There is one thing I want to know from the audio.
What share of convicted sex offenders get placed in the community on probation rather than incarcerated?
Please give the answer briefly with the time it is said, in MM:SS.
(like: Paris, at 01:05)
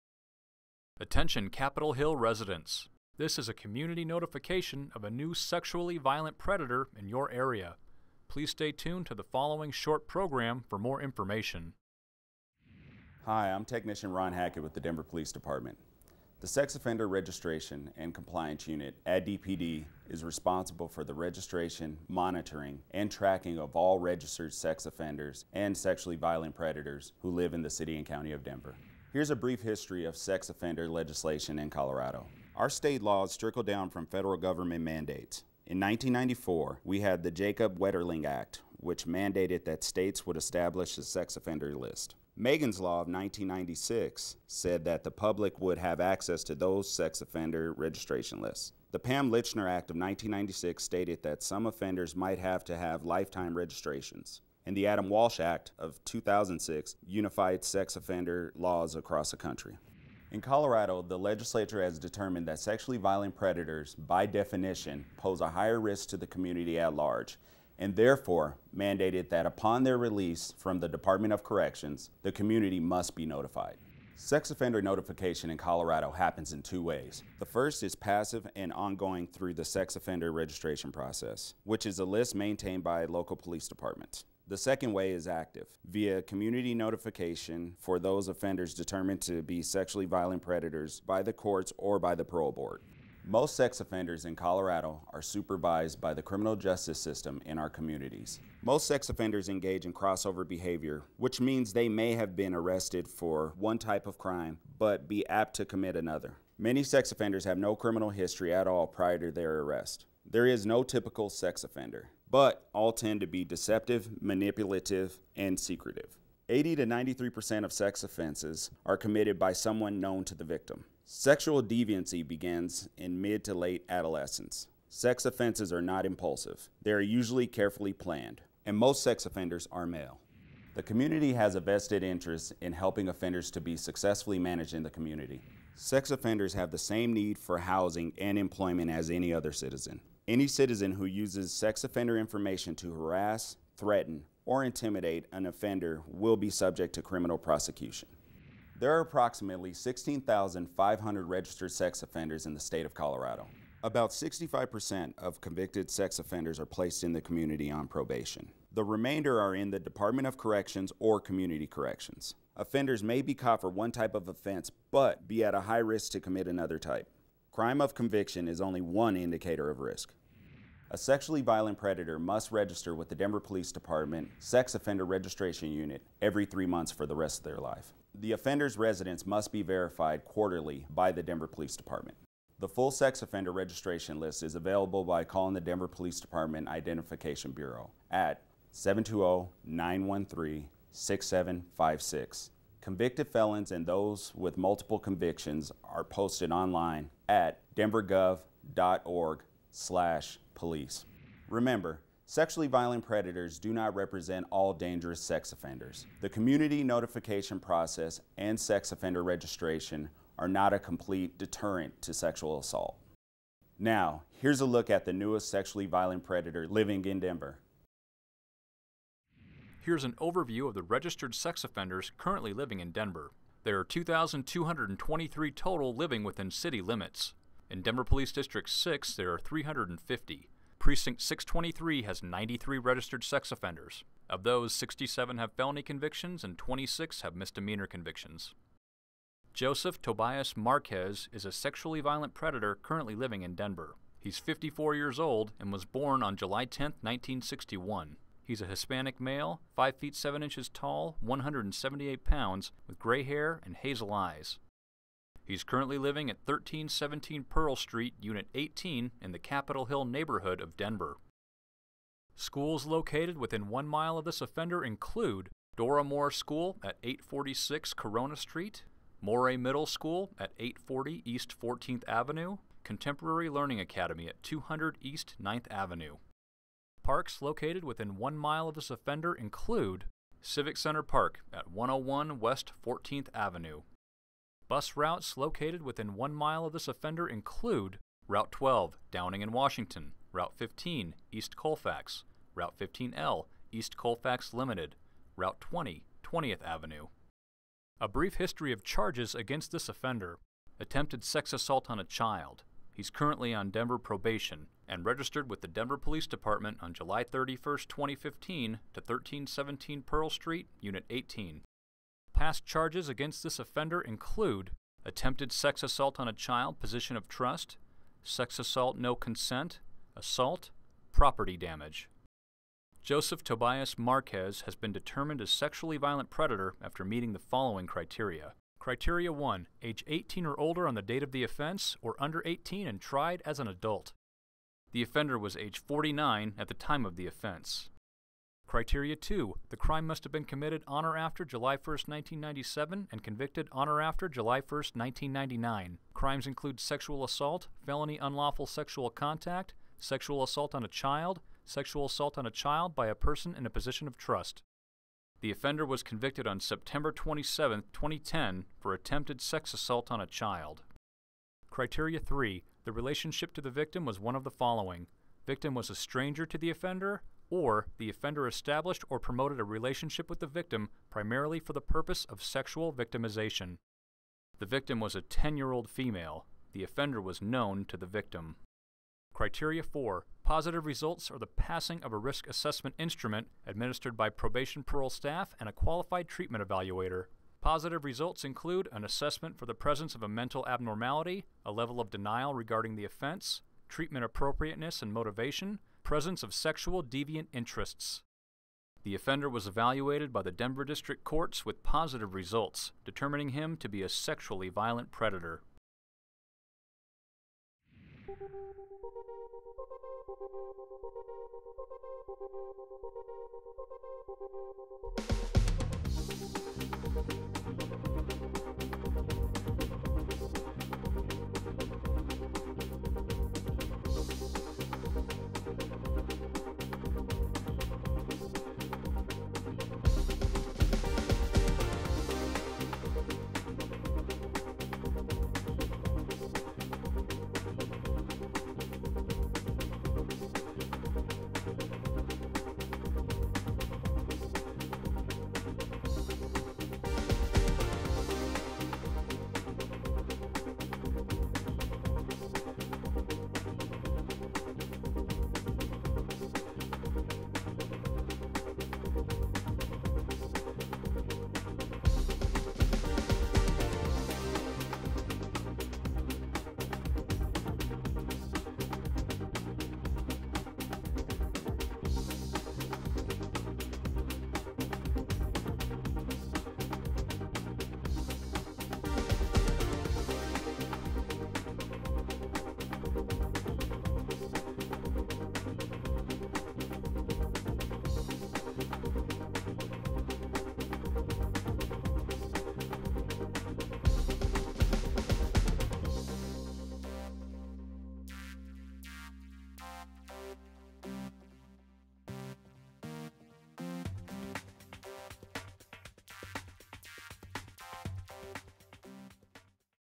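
65%, at 02:34.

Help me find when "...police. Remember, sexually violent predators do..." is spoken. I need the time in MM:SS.
03:20.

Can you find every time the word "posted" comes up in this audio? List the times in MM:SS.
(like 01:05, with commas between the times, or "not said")
03:16.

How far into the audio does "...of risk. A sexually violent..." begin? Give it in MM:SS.
02:49.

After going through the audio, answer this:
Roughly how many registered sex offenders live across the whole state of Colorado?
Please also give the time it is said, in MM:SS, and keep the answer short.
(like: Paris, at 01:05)
16,500, at 02:29.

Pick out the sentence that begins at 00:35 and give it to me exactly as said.
In 1994, we had the Jacob Wetterling Act, which mandated that states would establish a sex offender list.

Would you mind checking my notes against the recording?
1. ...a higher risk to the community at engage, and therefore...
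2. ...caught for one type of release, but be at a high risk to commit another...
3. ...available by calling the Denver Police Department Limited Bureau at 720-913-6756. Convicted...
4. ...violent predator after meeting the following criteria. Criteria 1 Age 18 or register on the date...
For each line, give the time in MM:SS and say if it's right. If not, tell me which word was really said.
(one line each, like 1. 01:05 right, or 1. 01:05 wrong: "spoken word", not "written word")
1. 01:05 wrong: "large", not "engage"
2. 02:43 wrong: "offense", not "release"
3. 03:04 wrong: "Identification", not "Limited"
4. 05:25 wrong: "older", not "register".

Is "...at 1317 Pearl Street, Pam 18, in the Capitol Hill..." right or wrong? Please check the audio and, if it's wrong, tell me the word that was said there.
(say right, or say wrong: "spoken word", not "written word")
wrong: "Unit", not "Pam".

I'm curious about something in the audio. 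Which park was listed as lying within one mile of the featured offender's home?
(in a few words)
Civic Center Park.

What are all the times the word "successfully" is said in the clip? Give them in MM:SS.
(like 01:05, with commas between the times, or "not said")
02:13.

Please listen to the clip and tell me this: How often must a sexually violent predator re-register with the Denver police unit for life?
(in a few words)
Every three months.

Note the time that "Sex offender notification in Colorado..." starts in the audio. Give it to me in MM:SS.
01:14.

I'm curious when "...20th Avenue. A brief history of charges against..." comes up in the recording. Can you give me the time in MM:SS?
04:56.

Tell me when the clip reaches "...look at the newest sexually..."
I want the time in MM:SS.
03:34.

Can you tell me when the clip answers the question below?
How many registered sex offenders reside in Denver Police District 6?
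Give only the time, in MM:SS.
03:49.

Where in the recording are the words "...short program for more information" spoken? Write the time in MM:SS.
00:09.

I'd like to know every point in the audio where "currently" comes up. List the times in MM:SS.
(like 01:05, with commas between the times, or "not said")
03:42, 04:02, 04:15, 05:03.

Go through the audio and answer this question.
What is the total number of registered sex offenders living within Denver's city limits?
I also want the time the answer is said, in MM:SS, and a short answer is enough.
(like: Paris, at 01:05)
2,223, at 03:43.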